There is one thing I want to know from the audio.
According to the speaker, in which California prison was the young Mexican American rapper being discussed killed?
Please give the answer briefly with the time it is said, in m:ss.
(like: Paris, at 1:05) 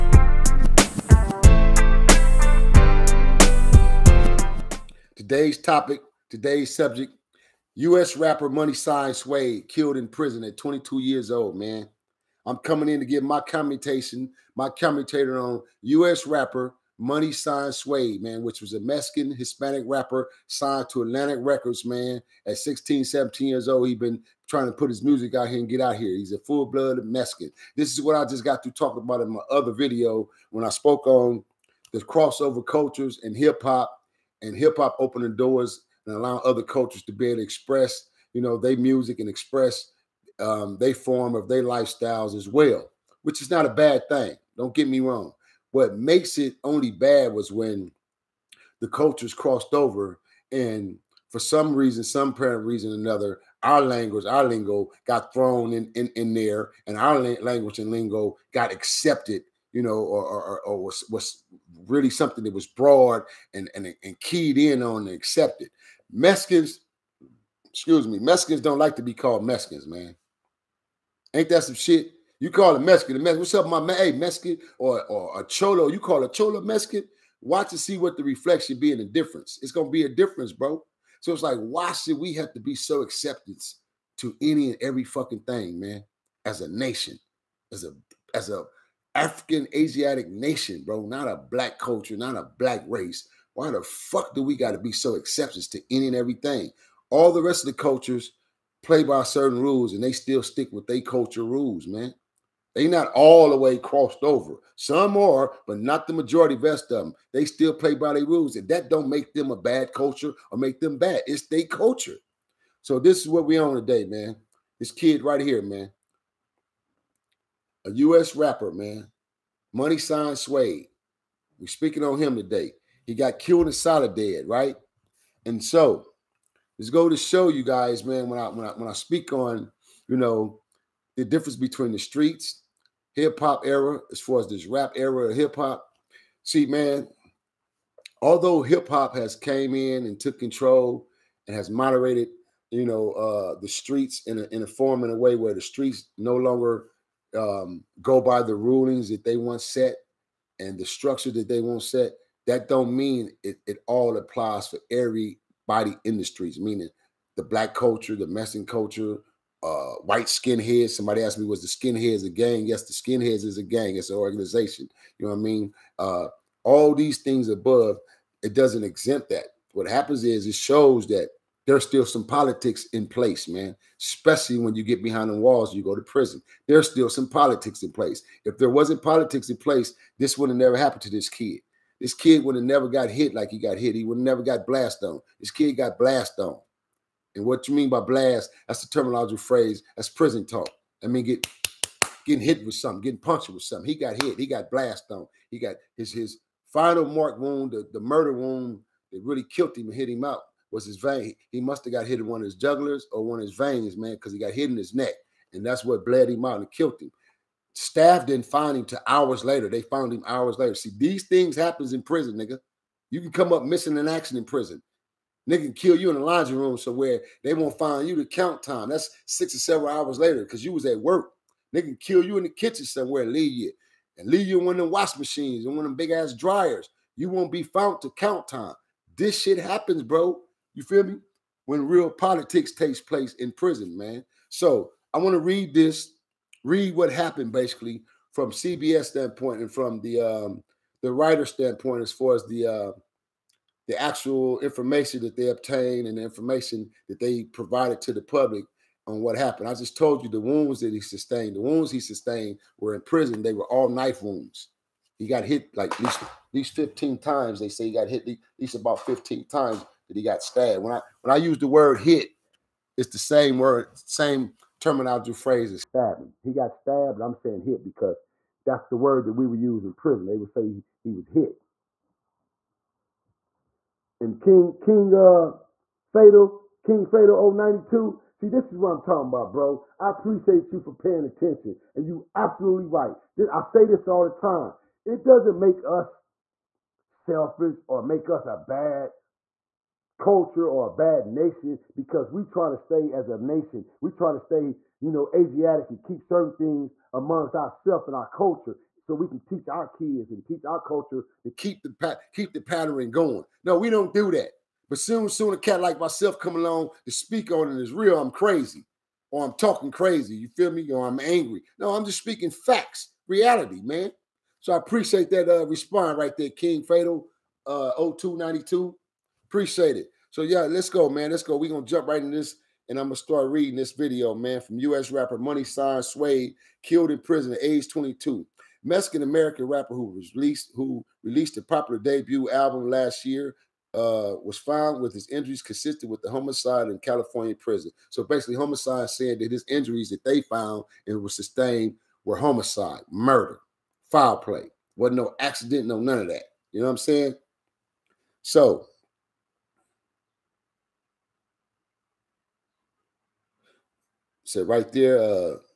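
Soledad, at 2:03.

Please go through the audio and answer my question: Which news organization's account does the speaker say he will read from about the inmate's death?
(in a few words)
CBS.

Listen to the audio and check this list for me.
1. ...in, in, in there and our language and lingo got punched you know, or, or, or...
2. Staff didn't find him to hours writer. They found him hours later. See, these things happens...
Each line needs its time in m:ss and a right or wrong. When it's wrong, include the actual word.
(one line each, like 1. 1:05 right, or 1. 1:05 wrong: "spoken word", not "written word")
1. 0:55 wrong: "accepted", not "punched"
2. 3:27 wrong: "later", not "writer".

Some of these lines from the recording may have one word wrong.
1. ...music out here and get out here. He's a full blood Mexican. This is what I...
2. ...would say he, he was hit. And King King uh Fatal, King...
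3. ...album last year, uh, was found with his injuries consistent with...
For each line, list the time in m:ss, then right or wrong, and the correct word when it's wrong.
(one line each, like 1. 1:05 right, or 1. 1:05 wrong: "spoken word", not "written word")
1. 0:25 right
2. 4:30 right
3. 5:32 right.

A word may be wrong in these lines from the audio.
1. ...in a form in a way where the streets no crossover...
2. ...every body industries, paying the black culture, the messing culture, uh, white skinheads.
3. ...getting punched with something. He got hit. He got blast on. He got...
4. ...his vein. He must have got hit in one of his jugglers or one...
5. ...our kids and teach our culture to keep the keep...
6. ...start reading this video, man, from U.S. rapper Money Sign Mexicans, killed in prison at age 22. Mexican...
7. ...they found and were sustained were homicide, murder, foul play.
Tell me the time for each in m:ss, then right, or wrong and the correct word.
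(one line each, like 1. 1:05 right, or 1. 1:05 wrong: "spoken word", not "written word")
1. 2:24 wrong: "longer", not "crossover"
2. 2:34 wrong: "meaning", not "paying"
3. 3:13 right
4. 3:20 right
5. 4:59 right
6. 5:23 wrong: "Suede", not "Mexicans"
7. 5:40 right.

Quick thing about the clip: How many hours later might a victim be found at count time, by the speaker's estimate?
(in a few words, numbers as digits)
6 or 7 hours.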